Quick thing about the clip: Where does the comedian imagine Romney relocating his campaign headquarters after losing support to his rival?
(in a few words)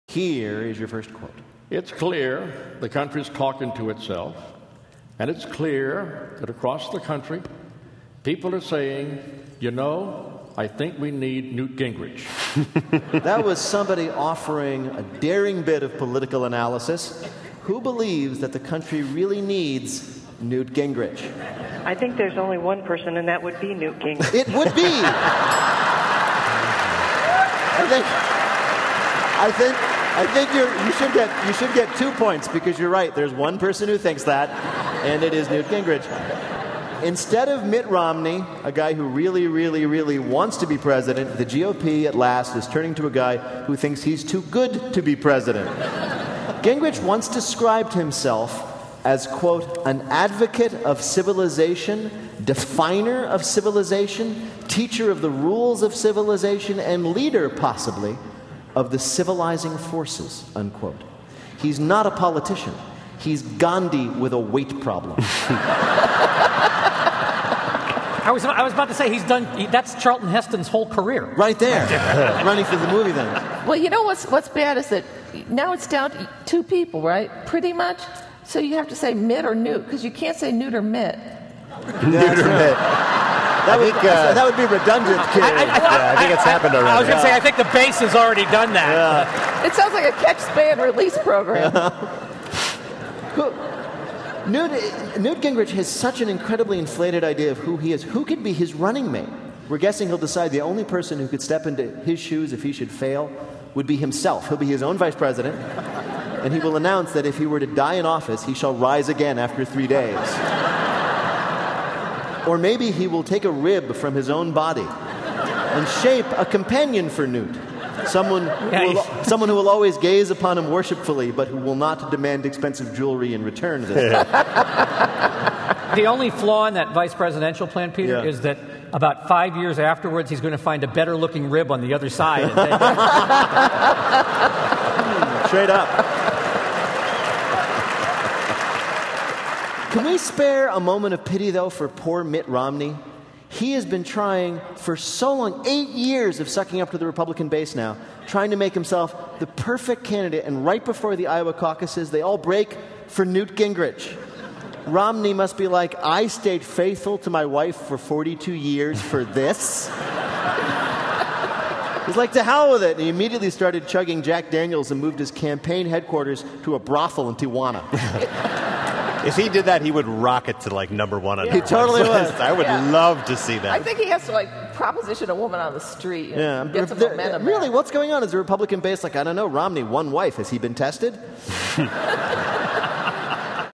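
Tijuana.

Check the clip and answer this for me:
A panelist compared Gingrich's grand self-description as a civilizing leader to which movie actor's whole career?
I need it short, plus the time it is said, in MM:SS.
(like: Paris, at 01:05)
Charlton Heston, at 01:10.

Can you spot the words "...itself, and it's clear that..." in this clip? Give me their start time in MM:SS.
00:03.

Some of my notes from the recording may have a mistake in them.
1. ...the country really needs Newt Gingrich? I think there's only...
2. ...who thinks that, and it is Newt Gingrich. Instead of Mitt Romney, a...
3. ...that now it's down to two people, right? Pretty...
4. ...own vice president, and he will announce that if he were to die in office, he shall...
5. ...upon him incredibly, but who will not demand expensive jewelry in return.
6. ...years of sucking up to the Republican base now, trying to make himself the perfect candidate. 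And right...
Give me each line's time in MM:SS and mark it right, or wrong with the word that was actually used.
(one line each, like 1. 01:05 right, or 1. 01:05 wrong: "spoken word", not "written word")
1. 00:18 right
2. 00:33 right
3. 01:14 right
4. 01:44 right
5. 02:00 wrong: "worshipfully", not "incredibly"
6. 02:25 right.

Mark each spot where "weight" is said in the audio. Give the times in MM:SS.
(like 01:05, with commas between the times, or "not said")
01:04.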